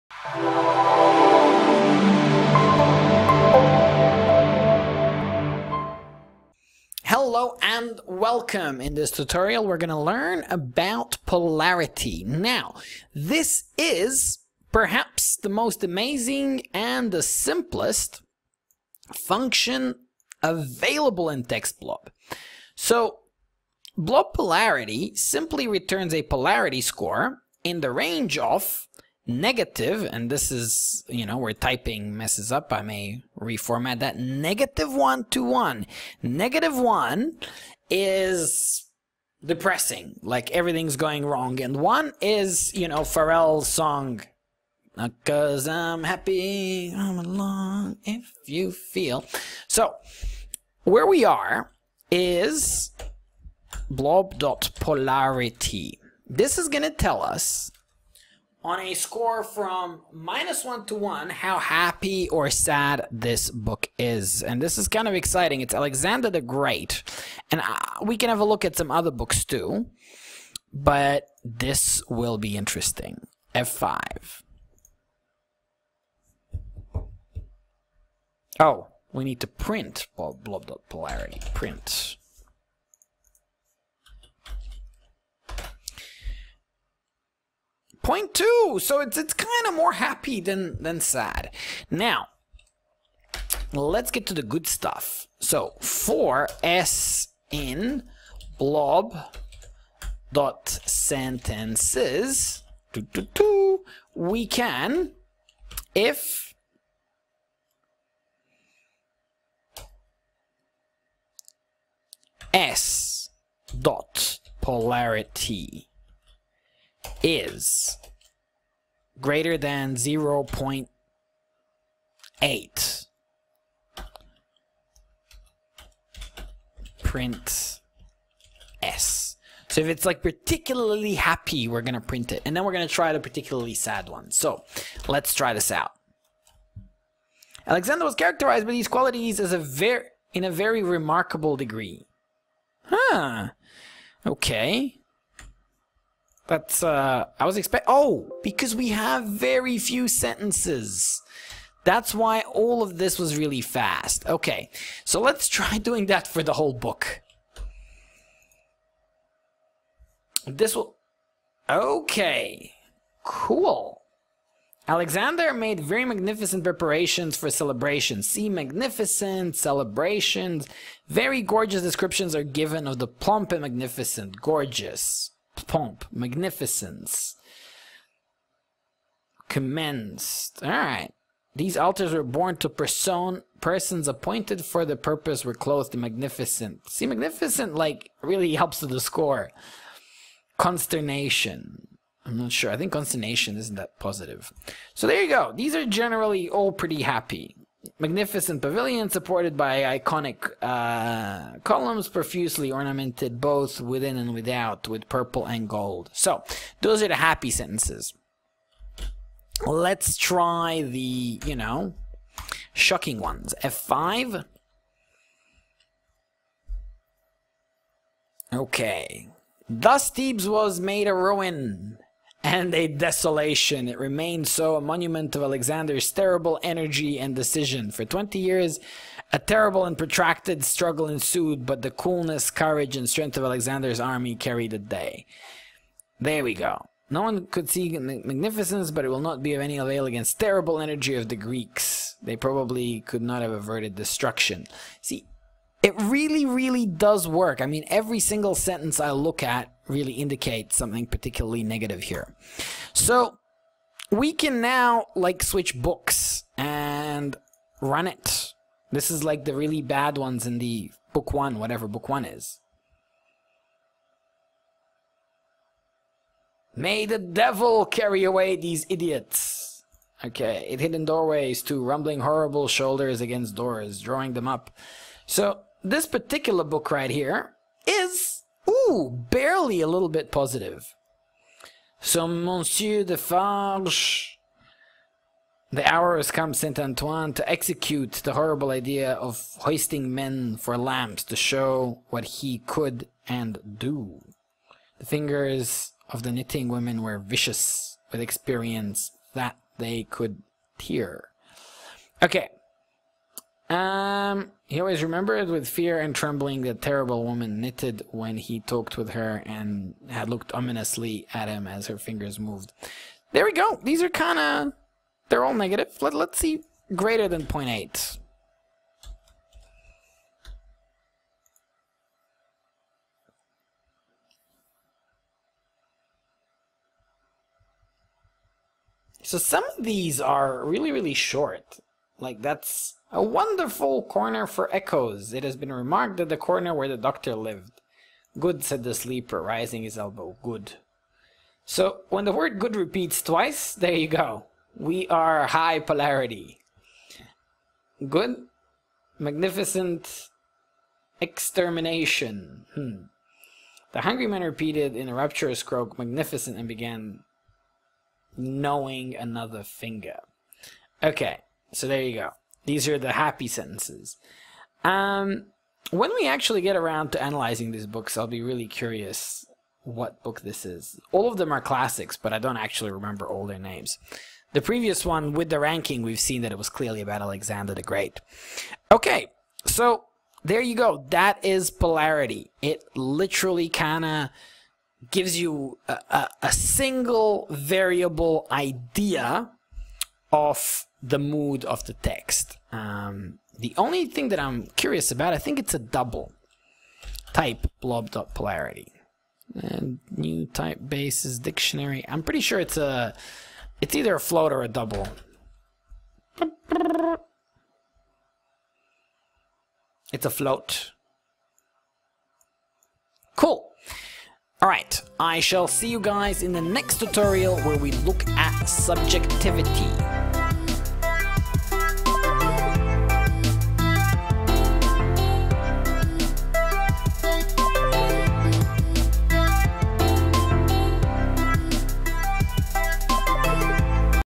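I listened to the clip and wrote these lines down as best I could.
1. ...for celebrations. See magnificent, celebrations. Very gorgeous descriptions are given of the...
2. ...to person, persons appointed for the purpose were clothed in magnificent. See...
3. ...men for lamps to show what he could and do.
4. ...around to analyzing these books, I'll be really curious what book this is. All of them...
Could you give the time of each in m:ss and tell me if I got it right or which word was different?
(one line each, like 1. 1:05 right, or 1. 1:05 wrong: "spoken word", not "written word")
1. 2:47 right
2. 3:02 right
3. 4:50 right
4. 6:06 right.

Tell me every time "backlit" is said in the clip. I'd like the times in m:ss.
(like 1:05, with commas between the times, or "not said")
not said.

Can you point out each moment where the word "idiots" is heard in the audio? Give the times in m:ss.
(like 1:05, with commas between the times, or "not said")
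4:28.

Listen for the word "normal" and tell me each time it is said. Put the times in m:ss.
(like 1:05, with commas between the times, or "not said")
not said.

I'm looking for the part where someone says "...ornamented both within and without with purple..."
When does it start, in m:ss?
3:22.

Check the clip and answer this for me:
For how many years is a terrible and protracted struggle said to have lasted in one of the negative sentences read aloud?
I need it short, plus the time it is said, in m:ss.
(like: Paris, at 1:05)
20, at 3:48.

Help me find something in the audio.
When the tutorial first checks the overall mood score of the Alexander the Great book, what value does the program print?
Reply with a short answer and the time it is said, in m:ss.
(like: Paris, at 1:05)
0.2, at 1:28.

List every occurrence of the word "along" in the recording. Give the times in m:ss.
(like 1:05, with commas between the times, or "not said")
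0:47.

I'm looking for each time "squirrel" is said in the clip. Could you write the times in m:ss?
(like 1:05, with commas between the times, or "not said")
not said.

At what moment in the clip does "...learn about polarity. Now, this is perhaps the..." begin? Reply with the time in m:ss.
0:09.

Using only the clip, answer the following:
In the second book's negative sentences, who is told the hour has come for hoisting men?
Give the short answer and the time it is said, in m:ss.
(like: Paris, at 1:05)
Monsieur Defarge, at 4:42.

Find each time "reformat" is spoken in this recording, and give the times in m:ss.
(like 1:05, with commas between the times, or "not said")
0:33.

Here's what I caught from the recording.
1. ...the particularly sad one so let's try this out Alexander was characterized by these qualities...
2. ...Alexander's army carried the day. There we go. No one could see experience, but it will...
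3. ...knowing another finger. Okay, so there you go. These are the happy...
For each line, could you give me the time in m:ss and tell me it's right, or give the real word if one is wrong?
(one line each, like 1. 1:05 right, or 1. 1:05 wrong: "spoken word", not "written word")
1. 2:13 right
2. 3:53 wrong: "magnificence", not "experience"
3. 5:58 right.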